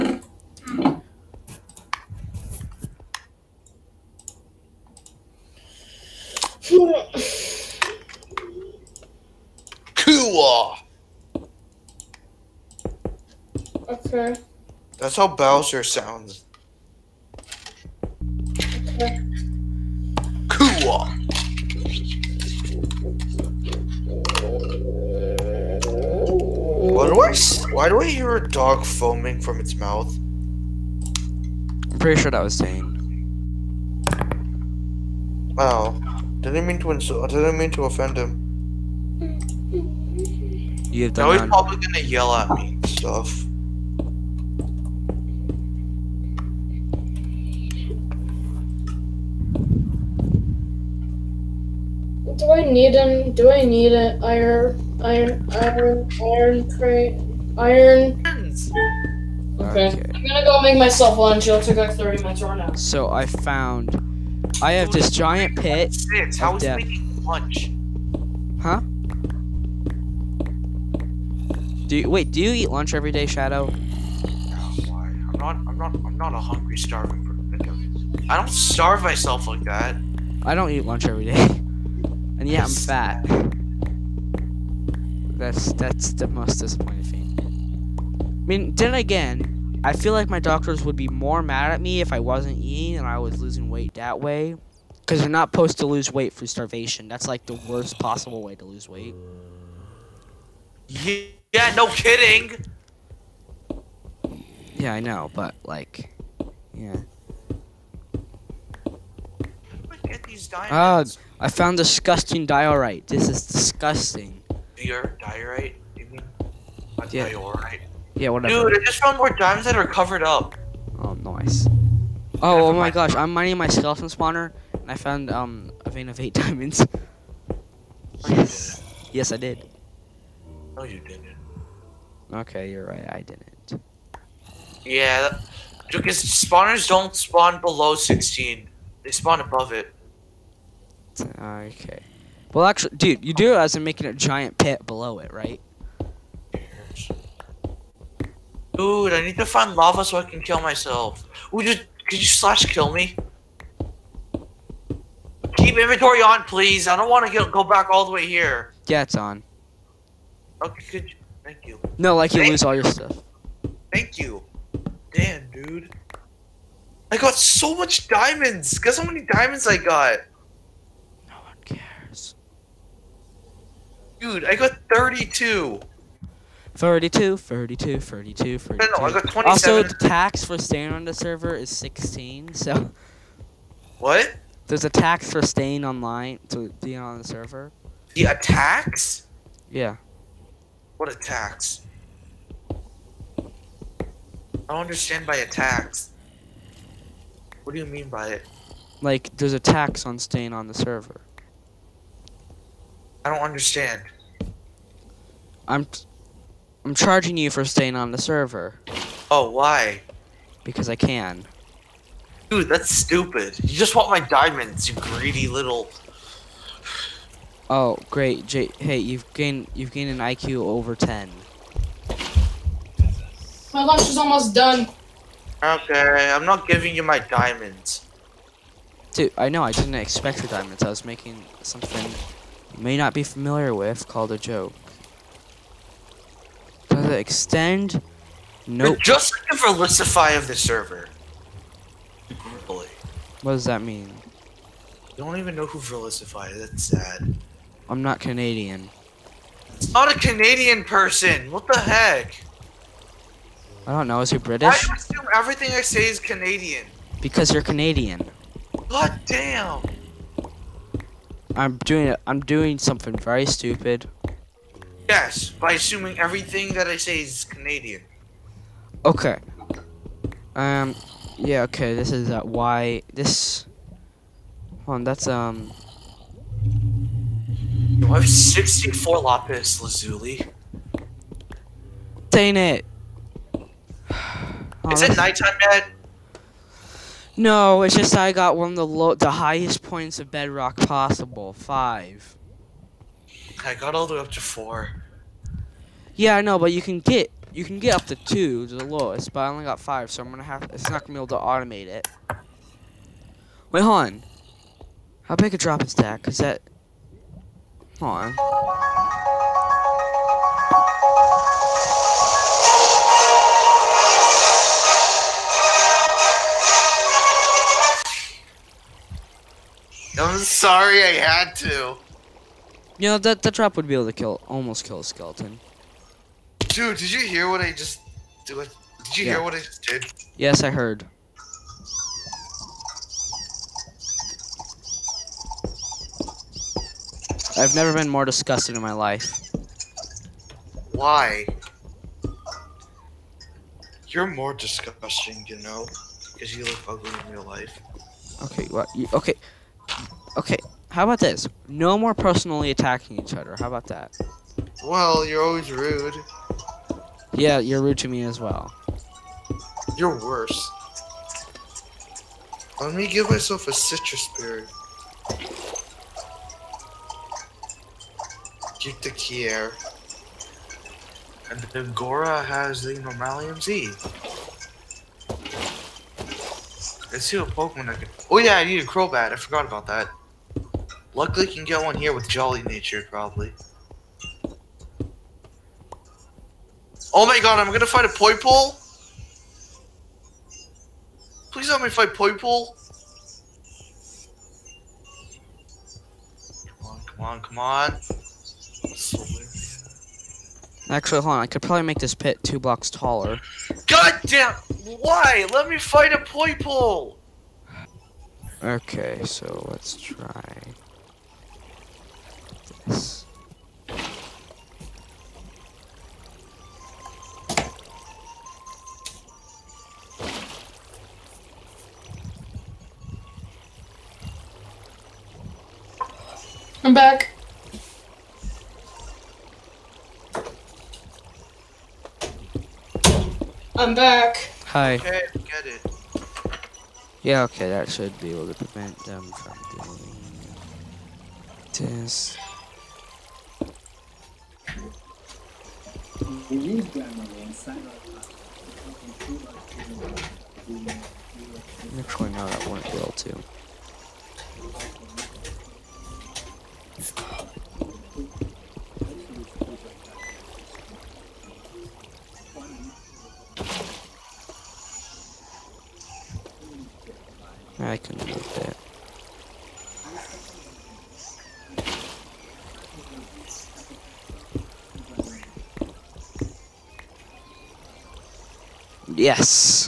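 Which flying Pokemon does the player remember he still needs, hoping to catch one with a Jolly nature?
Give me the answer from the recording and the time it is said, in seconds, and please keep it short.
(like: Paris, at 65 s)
Crobat, at 378 s.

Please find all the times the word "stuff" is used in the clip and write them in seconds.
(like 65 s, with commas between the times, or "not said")
42 s, 162 s.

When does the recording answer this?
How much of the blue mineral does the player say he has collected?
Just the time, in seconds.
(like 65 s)
278 s.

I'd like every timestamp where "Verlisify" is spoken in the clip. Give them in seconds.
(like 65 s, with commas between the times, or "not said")
239 s, 245 s.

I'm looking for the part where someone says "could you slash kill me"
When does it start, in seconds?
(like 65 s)
152 s.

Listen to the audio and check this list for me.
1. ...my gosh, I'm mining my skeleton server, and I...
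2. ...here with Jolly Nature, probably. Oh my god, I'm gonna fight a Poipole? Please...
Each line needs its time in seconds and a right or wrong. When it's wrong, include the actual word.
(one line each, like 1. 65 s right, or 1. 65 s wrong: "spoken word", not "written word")
1. 122 s wrong: "spawner", not "server"
2. 381 s right.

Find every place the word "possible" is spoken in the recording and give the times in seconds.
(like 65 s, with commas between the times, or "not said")
97 s, 290 s.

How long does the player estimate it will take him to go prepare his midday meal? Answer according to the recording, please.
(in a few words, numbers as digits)
30 minutes.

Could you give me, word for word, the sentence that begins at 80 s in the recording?
I don't eat lunch every day.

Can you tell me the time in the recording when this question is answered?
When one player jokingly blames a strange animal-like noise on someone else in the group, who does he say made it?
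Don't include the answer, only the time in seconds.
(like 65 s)
32 s.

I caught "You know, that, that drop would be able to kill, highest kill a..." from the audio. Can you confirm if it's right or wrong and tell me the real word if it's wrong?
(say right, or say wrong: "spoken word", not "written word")
wrong: "almost", not "highest".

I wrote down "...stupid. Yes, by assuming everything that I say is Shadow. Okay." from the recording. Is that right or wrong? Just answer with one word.
wrong.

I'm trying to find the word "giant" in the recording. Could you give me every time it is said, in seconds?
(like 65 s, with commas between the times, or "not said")
65 s, 144 s.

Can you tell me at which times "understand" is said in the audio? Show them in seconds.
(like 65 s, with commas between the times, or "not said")
194 s, 203 s.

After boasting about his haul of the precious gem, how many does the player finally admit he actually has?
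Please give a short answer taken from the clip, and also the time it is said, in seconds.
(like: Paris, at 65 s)
27, at 179 s.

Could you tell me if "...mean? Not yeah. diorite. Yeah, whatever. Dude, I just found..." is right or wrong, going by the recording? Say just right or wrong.
right.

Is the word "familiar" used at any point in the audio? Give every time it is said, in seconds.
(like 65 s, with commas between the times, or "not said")
233 s.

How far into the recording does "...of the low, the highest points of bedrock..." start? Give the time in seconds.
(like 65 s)
288 s.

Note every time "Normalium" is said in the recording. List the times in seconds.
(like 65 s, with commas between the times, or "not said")
372 s.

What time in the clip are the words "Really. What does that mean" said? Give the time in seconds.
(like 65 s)
242 s.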